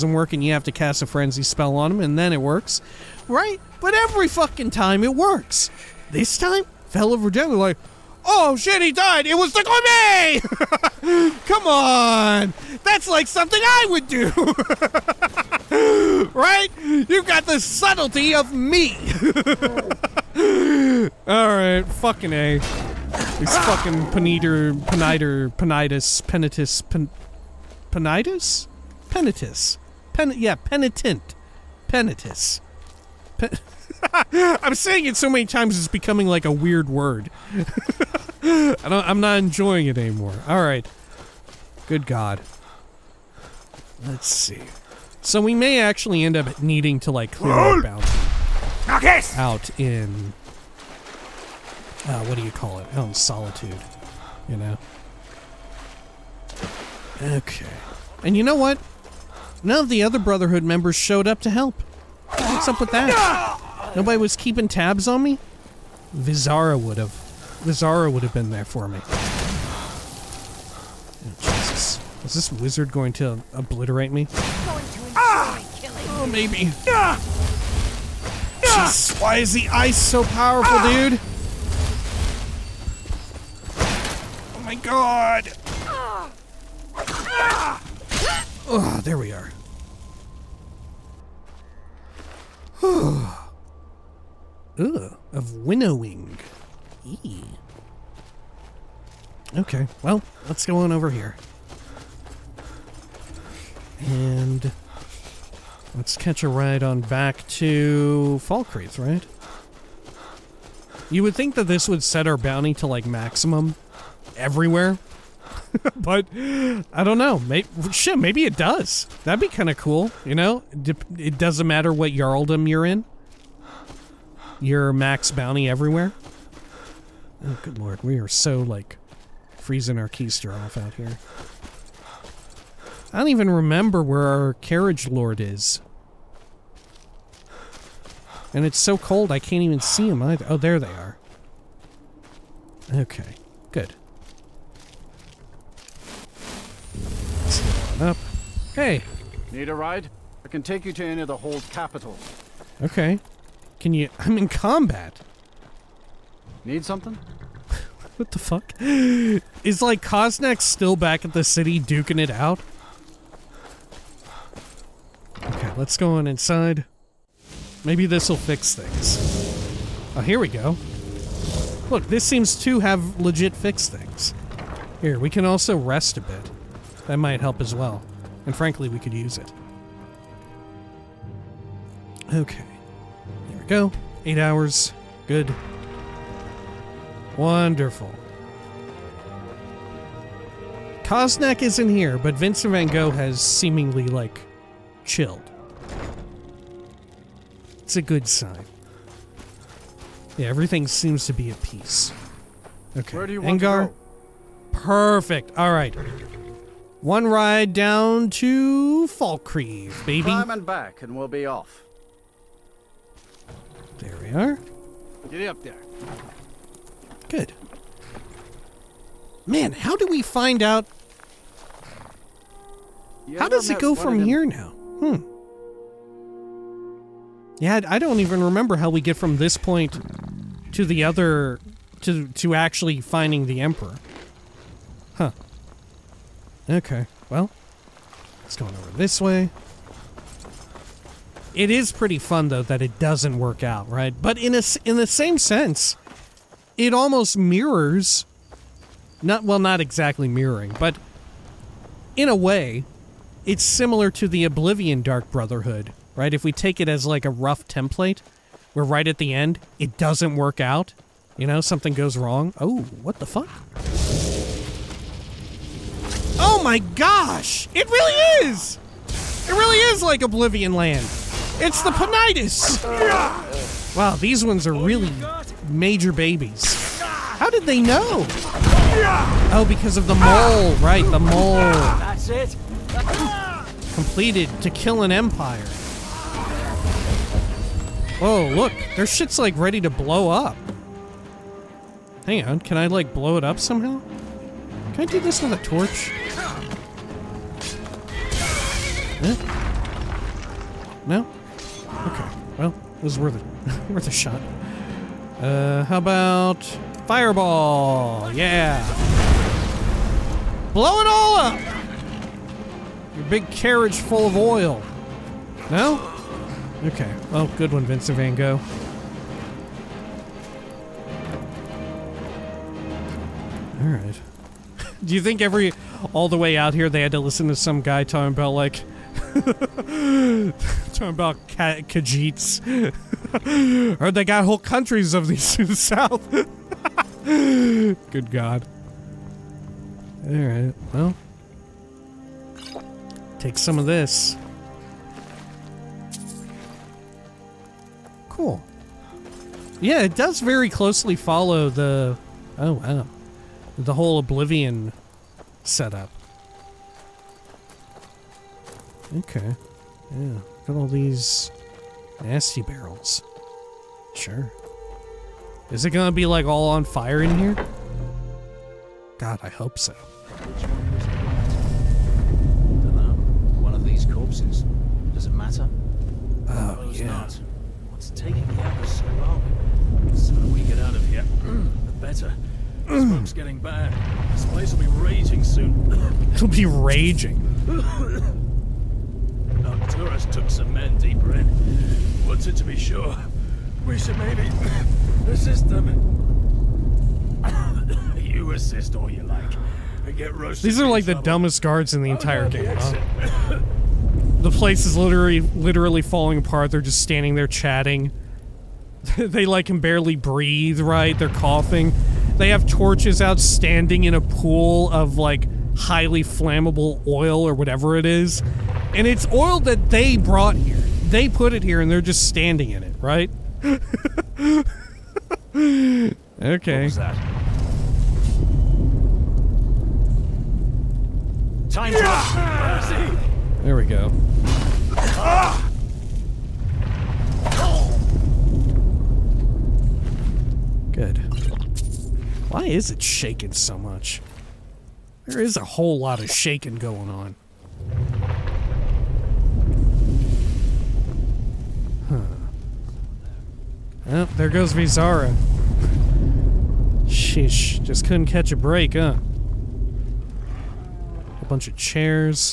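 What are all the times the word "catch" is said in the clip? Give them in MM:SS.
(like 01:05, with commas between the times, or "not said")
01:46, 07:38.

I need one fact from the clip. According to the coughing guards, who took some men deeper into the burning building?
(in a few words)
Arcturus.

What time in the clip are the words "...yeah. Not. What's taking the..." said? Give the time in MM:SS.
06:16.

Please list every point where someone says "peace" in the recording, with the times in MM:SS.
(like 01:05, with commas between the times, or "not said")
03:21.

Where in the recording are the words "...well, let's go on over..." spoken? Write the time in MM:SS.
01:40.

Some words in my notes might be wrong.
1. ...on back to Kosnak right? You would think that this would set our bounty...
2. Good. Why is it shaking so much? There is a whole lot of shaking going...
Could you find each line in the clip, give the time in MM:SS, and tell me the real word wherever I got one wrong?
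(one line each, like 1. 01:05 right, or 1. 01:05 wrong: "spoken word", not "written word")
1. 01:46 wrong: "Fall", not "Kosnak"
2. 07:20 right.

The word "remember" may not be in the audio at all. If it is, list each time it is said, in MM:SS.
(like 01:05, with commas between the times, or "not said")
02:13, 03:48.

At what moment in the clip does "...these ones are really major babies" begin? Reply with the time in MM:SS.
04:34.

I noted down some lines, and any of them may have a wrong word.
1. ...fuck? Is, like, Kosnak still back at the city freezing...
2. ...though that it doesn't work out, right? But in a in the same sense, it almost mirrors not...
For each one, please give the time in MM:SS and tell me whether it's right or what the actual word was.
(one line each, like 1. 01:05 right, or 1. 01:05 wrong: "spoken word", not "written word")
1. 02:38 wrong: "duking", not "freezing"
2. 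04:02 right.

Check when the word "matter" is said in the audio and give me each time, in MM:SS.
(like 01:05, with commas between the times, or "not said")
02:01, 06:15.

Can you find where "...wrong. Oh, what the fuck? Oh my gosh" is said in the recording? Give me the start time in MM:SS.
04:22.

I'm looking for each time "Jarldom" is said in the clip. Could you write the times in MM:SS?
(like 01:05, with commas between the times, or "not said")
02:02.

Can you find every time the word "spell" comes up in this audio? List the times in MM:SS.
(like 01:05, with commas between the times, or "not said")
00:01.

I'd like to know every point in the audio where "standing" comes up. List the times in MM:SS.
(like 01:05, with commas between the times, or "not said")
06:47, 06:53, 07:02.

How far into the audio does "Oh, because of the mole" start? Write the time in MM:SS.
04:39.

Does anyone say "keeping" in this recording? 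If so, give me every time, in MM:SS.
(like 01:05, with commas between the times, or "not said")
01:04.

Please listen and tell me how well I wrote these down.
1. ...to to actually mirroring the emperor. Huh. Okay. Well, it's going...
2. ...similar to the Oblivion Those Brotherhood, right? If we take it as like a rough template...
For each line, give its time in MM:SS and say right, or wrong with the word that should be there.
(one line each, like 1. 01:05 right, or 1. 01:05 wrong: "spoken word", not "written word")
1. 03:52 wrong: "finding", not "mirroring"
2. 04:13 wrong: "Dark", not "Those".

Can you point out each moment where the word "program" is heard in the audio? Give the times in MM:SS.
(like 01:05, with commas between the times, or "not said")
not said.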